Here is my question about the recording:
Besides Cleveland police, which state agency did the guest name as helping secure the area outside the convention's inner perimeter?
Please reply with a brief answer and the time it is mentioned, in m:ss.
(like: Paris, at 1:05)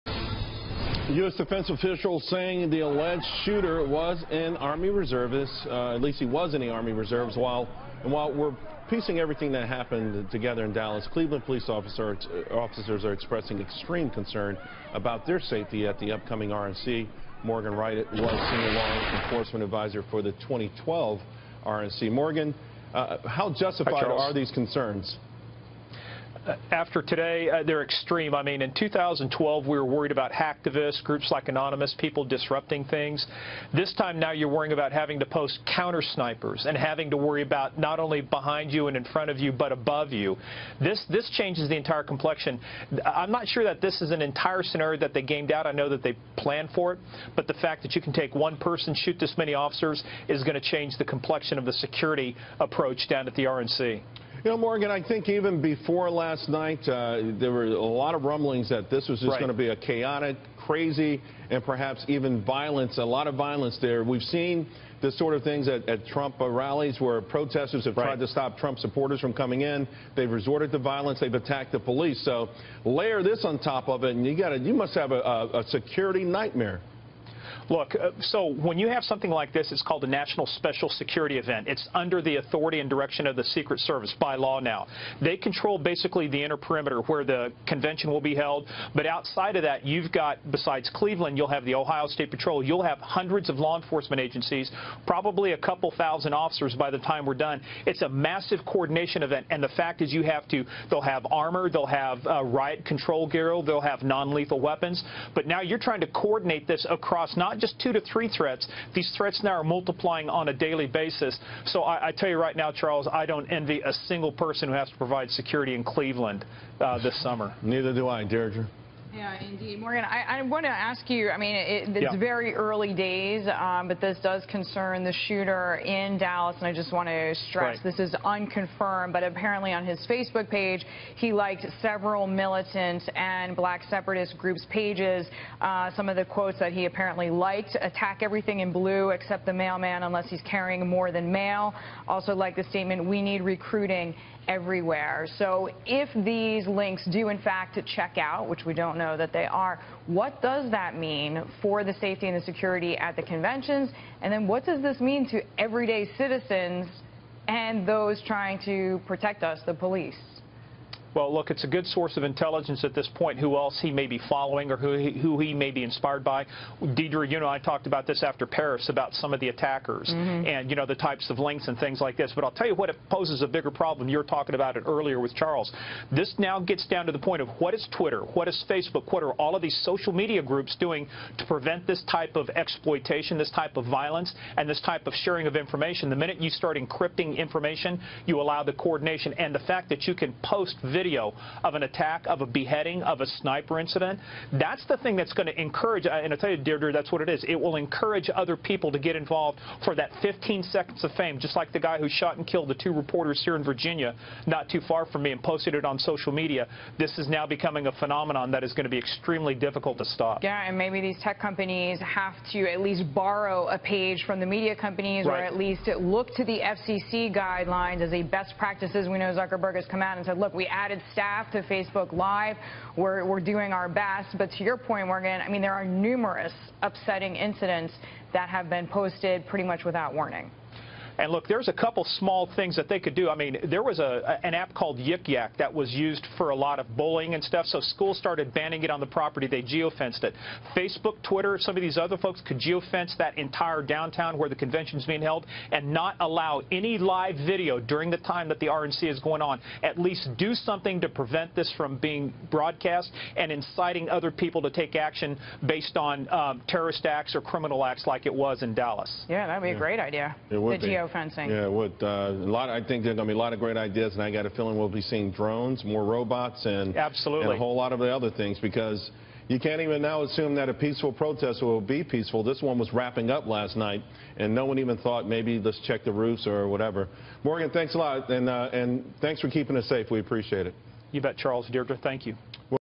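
Ohio State Patrol, at 1:31.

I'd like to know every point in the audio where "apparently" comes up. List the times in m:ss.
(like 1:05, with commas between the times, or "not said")
2:09, 2:16.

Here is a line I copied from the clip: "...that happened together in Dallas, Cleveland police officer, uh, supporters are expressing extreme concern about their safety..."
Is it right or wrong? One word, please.
wrong.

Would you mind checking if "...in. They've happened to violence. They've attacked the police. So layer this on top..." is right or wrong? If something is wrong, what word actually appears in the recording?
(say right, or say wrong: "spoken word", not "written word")
wrong: "resorted", not "happened".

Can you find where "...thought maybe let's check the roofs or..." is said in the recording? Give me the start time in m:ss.
4:34.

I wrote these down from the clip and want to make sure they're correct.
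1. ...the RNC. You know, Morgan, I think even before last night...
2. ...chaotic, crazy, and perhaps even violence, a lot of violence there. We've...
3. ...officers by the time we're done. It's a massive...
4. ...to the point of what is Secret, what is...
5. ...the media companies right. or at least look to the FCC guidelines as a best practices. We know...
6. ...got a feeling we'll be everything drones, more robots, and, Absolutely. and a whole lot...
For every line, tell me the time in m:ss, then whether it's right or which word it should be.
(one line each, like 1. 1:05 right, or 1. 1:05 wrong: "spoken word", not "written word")
1. 0:53 right
2. 0:59 right
3. 1:36 right
4. 2:57 wrong: "Twitter", not "Secret"
5. 3:34 right
6. 4:24 wrong: "seeing", not "everything".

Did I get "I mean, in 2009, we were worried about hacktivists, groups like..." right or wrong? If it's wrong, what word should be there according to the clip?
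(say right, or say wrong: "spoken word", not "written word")
wrong: "2012", not "2009".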